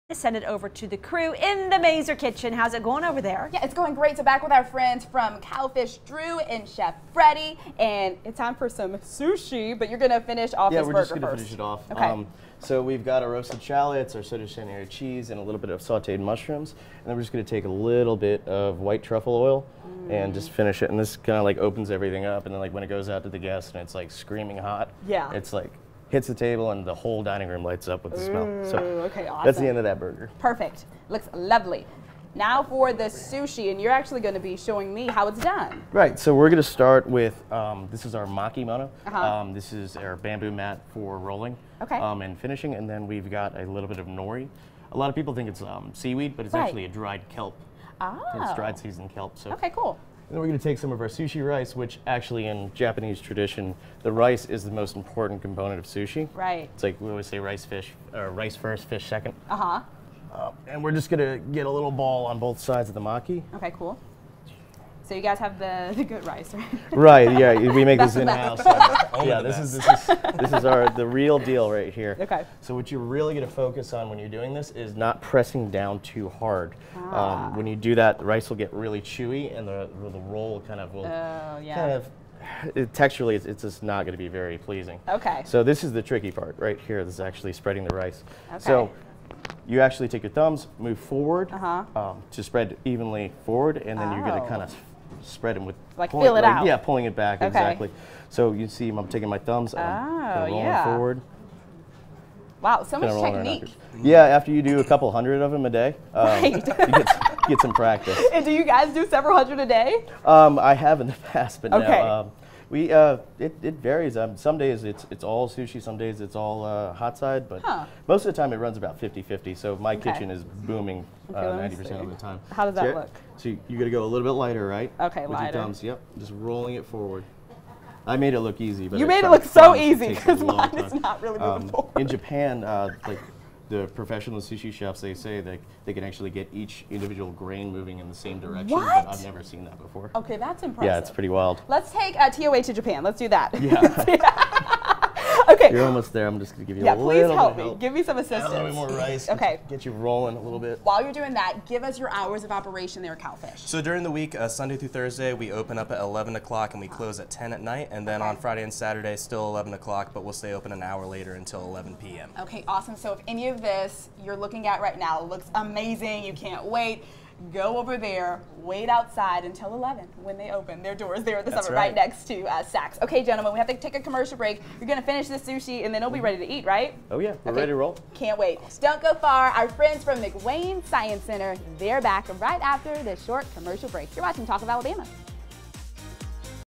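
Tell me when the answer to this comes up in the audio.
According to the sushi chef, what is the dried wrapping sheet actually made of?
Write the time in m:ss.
0:46.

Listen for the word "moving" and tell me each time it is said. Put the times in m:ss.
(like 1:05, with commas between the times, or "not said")
2:11, 2:17.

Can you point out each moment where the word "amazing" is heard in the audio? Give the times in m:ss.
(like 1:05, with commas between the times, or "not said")
2:45.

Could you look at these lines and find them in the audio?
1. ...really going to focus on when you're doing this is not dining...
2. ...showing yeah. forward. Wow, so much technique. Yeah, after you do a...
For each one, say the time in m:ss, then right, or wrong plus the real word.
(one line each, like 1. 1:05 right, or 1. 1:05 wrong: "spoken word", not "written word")
1. 1:13 wrong: "pressing", not "dining"
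2. 1:40 wrong: "rolling", not "showing".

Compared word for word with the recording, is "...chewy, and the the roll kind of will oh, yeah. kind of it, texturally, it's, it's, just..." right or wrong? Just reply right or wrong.
right.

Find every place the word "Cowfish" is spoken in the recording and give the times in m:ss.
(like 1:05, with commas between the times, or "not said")
0:05, 2:33.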